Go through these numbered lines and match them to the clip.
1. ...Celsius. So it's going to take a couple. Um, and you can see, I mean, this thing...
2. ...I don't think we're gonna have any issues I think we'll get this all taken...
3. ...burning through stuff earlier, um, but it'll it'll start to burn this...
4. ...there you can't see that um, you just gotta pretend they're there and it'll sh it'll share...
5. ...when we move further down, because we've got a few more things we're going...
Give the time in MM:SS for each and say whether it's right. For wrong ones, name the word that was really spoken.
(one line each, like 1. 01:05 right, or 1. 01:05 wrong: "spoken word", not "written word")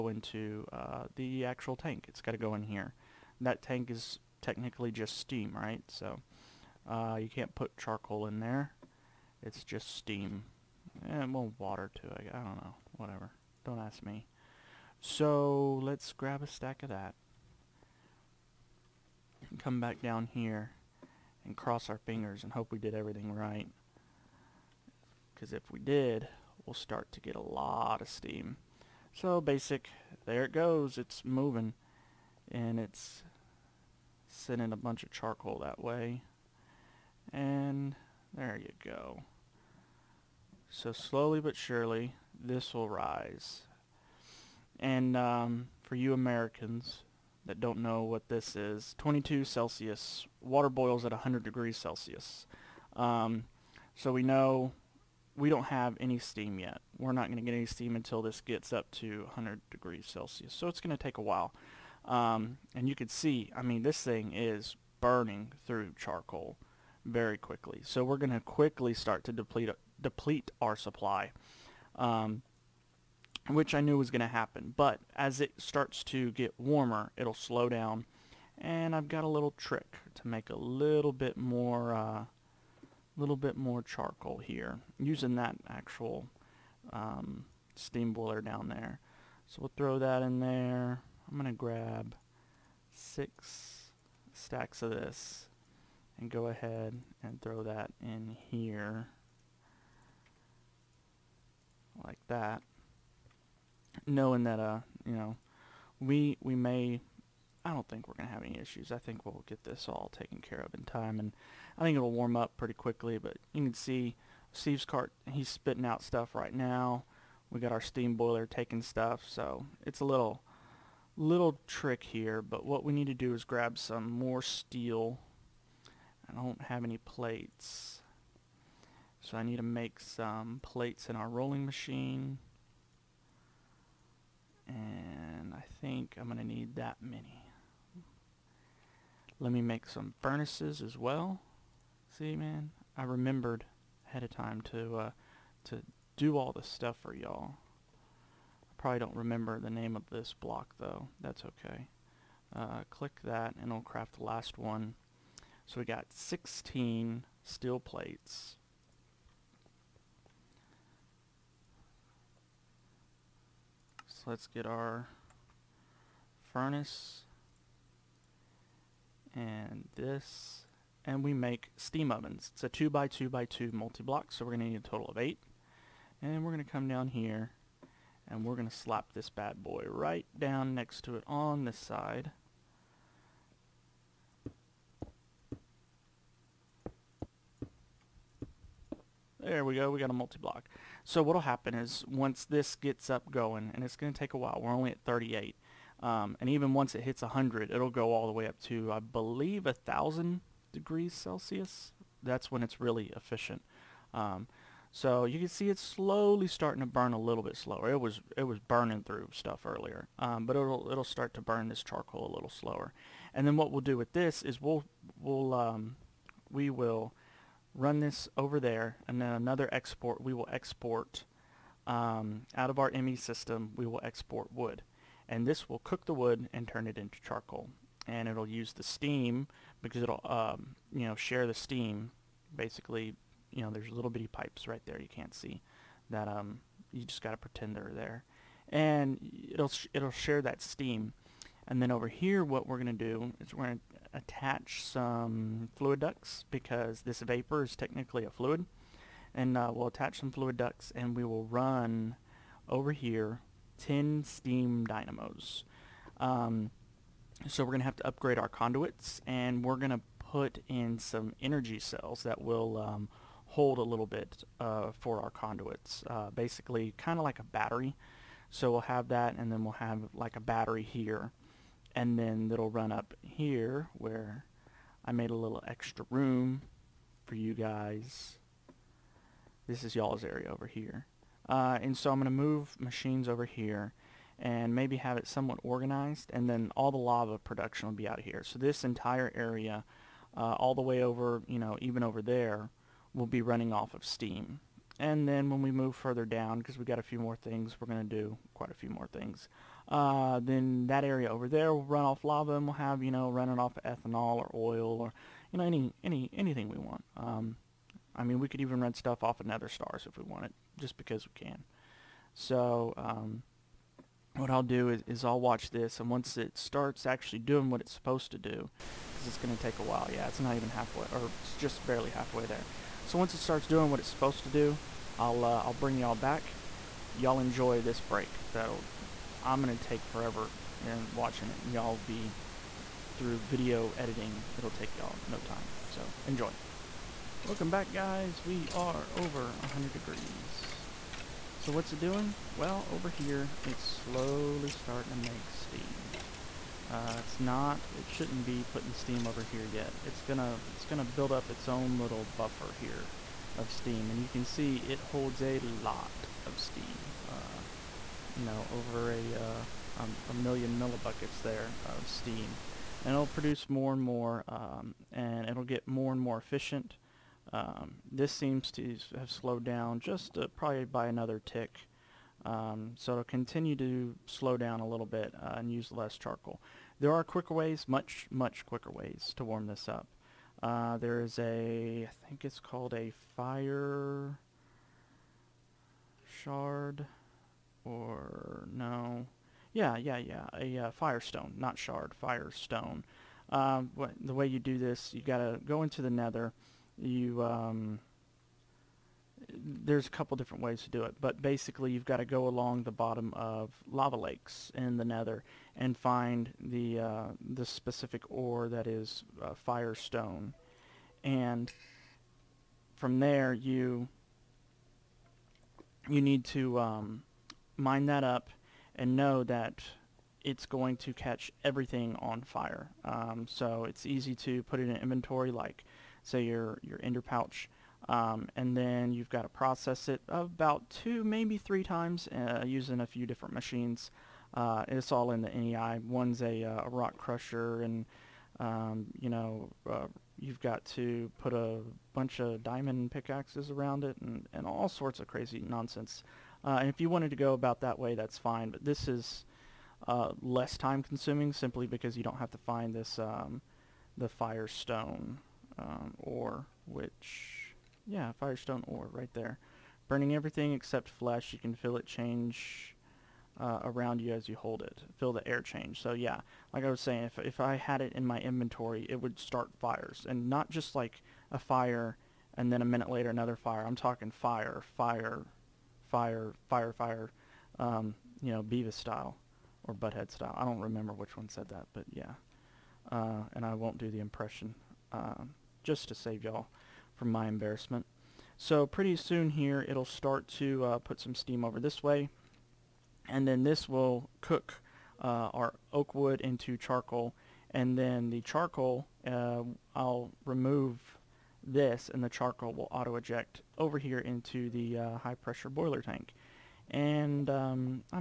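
1. 01:00 wrong: "while", not "couple"
2. 01:47 right
3. 03:28 right
4. 03:54 right
5. 04:55 right.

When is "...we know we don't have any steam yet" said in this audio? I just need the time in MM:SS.
00:54.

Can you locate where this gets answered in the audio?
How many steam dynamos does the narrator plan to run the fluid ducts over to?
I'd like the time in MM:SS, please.
04:13.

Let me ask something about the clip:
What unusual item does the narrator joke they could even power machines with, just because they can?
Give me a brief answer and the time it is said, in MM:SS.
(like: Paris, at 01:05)
nether stars, at 05:09.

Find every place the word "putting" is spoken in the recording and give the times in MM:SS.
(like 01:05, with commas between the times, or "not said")
05:48.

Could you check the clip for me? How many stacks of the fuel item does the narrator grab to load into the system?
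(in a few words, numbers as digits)
6.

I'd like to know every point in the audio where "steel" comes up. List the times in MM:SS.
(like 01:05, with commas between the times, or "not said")
02:04, 02:37.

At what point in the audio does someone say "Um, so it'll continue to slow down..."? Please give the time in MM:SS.
06:12.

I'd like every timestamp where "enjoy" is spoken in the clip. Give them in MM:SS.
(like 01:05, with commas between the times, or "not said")
05:27, 05:36.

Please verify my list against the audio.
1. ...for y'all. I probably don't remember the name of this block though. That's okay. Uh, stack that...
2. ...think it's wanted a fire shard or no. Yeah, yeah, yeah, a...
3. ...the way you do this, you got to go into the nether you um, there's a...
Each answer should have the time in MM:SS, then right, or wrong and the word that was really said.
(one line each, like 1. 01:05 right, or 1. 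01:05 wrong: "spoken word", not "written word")
1. 02:27 wrong: "click", not "stack"
2. 06:22 wrong: "called", not "wanted"
3. 06:34 right.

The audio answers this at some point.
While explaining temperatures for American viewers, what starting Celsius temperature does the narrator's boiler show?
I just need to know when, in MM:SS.
00:48.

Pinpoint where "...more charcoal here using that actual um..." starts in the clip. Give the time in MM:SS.
01:23.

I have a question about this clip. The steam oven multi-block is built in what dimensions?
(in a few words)
2 by 2 by 2.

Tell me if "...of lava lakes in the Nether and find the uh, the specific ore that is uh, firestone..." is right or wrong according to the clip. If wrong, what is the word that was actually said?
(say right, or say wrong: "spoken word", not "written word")
right.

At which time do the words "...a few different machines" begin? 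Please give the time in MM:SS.
07:13.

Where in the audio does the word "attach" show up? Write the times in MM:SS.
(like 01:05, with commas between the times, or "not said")
04:04, 04:09.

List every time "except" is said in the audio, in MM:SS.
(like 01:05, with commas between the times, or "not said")
07:40.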